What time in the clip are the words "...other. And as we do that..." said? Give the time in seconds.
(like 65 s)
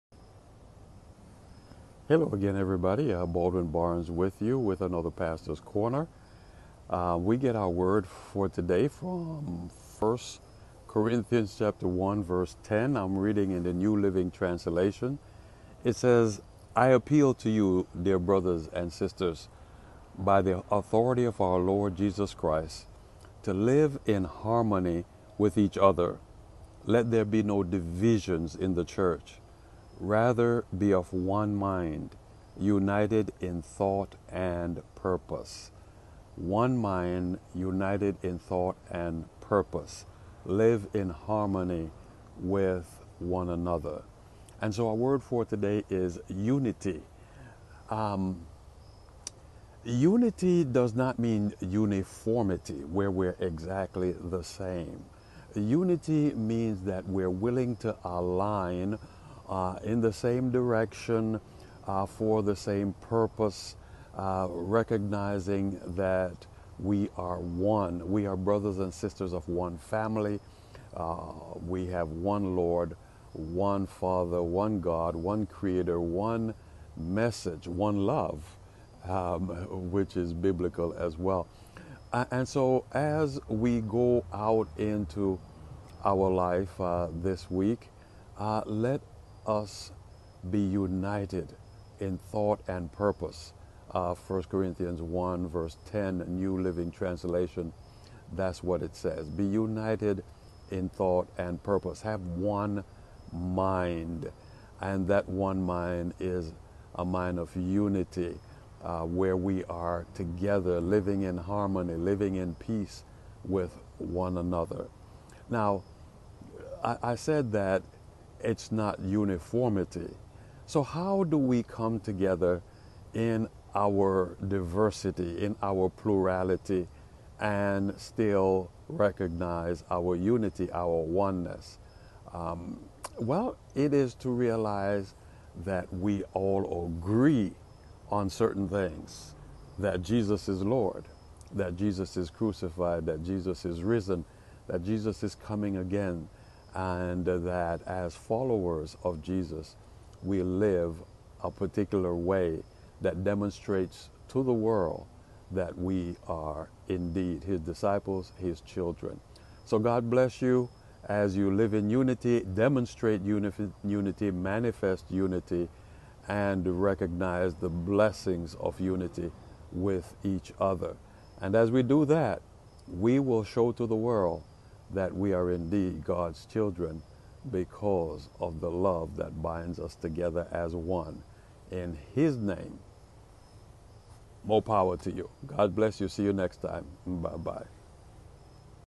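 170 s.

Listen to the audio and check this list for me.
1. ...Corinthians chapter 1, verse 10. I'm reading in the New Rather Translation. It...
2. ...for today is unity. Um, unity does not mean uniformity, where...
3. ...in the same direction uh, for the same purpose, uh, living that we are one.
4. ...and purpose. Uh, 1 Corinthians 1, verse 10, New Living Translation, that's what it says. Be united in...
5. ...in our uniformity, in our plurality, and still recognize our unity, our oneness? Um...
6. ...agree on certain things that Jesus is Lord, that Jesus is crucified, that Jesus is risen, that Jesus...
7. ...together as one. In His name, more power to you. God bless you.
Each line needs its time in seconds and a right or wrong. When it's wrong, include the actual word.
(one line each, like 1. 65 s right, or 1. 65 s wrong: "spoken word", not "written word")
1. 10 s wrong: "Living", not "Rather"
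2. 45 s right
3. 59 s wrong: "recognizing", not "living"
4. 92 s right
5. 123 s wrong: "diversity", not "uniformity"
6. 136 s right
7. 179 s right.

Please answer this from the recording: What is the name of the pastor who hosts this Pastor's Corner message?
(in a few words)
Baldwin Barnes.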